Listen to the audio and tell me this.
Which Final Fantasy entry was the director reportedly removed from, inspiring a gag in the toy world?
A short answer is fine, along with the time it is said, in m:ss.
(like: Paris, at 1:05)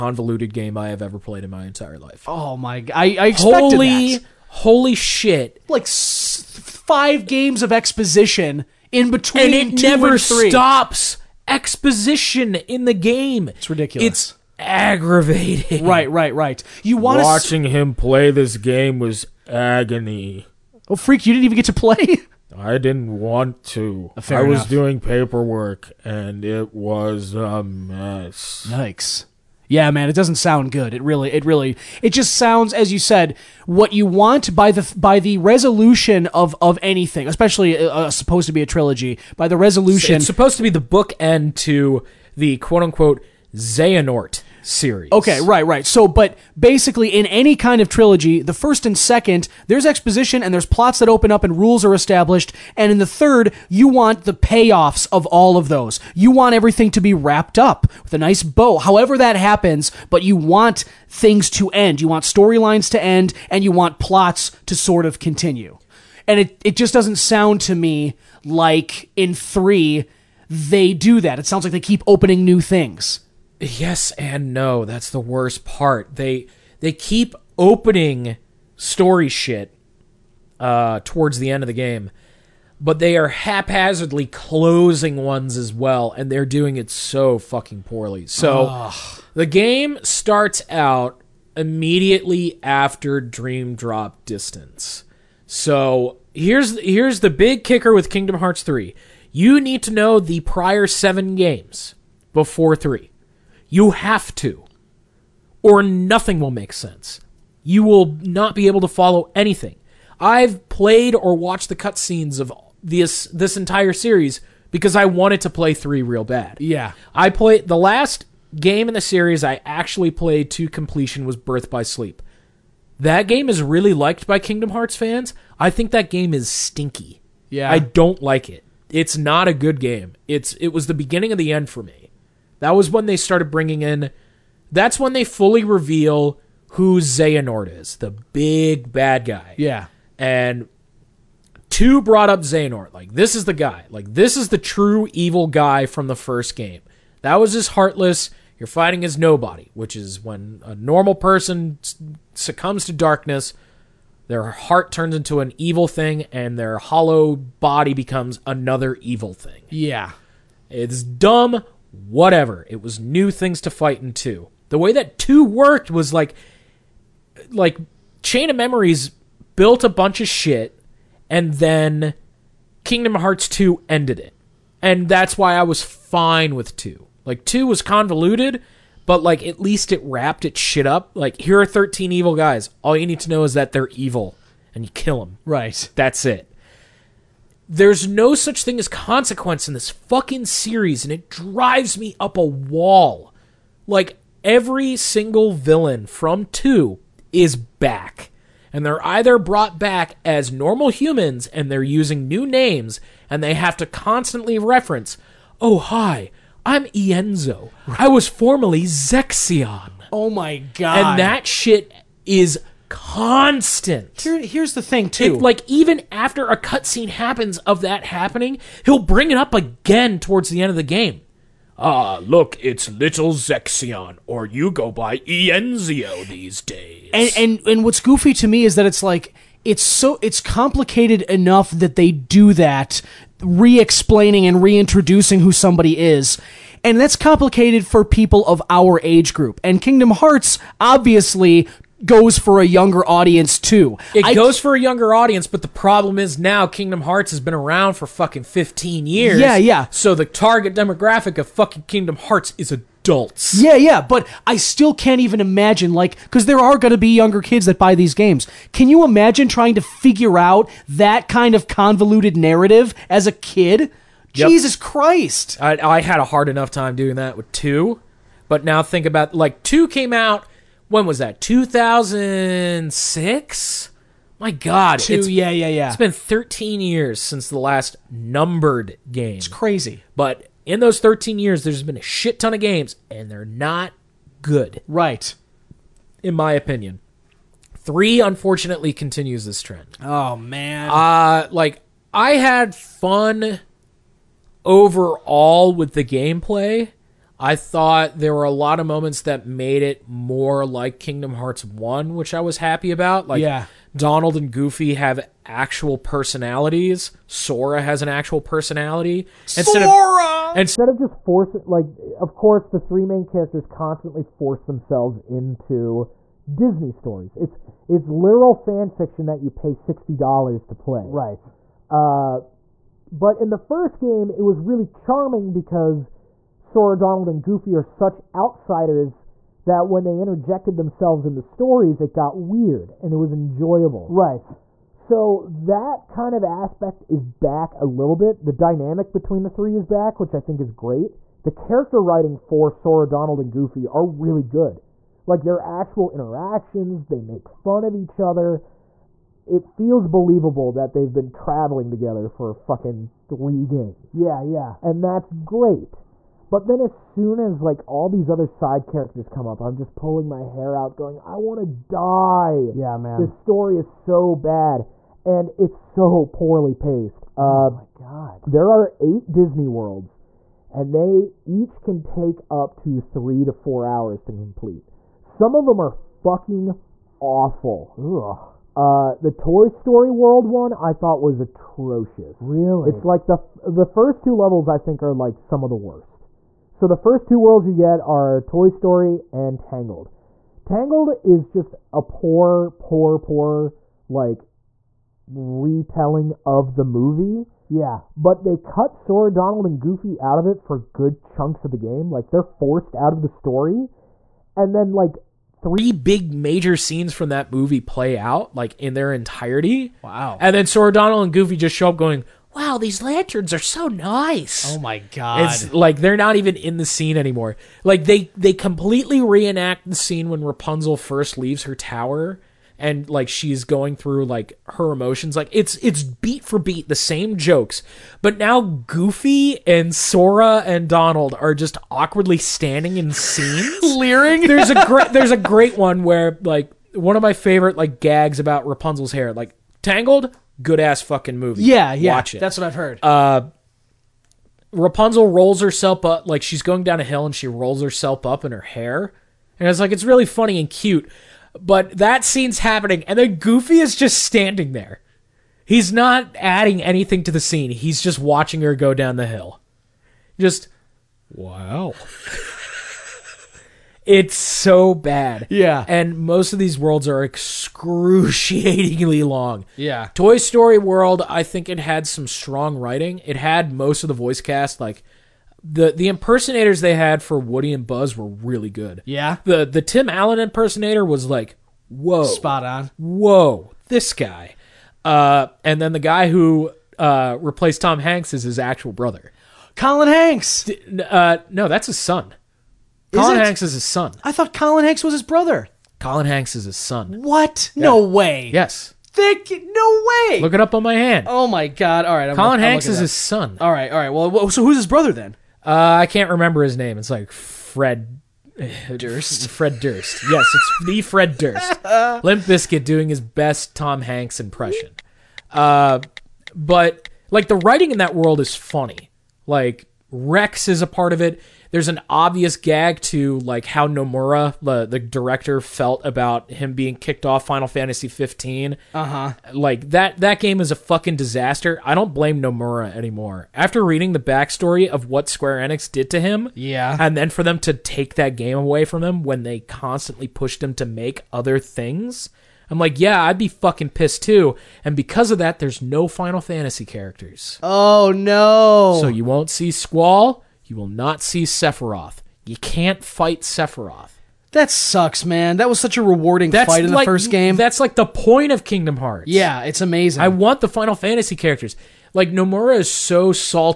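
Final Fantasy 15, at 8:47.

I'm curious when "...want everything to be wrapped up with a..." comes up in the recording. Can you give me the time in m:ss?
0:56.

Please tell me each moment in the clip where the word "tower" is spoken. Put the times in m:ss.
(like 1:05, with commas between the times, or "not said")
7:01.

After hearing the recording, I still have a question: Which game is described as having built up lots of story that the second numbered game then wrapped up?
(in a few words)
Chain of Memories.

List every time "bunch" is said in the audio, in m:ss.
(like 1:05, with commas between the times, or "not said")
2:49.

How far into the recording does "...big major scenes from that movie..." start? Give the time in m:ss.
6:45.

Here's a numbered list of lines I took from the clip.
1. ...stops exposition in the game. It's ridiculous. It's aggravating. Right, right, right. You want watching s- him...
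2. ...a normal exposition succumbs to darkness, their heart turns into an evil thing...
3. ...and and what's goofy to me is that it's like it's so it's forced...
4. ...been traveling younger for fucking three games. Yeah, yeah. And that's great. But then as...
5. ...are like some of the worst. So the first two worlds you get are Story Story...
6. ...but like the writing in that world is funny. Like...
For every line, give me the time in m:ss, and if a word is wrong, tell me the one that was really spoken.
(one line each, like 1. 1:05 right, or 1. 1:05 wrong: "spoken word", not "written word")
1. 0:10 right
2. 2:30 wrong: "person", not "exposition"
3. 3:47 wrong: "complicated", not "forced"
4. 5:51 wrong: "together", not "younger"
5. 6:25 wrong: "Toy", not "Story"
6. 8:36 right.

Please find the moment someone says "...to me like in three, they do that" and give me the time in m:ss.
1:07.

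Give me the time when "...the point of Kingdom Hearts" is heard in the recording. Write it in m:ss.
9:17.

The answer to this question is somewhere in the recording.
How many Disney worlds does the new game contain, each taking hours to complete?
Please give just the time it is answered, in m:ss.
6:08.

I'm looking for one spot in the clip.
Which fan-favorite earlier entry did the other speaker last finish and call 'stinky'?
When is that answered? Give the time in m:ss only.
2:01.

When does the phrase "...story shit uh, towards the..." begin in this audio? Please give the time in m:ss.
1:18.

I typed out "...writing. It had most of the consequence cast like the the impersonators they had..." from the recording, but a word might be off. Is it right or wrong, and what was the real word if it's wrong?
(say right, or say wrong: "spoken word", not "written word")
wrong: "voice", not "consequence".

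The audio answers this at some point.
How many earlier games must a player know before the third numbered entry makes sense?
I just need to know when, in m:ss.
1:40.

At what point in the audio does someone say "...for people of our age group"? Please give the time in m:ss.
3:57.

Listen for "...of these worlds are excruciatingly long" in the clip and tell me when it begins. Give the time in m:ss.
7:46.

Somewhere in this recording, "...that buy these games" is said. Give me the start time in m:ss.
4:17.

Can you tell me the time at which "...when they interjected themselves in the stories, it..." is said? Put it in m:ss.
5:29.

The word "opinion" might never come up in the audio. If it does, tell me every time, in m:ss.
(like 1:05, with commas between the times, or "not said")
4:46.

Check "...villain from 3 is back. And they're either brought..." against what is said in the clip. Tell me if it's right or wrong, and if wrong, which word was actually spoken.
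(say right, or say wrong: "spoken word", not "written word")
wrong: "2", not "3".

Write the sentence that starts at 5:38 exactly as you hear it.
The dynamic between the three is back, which I think is great.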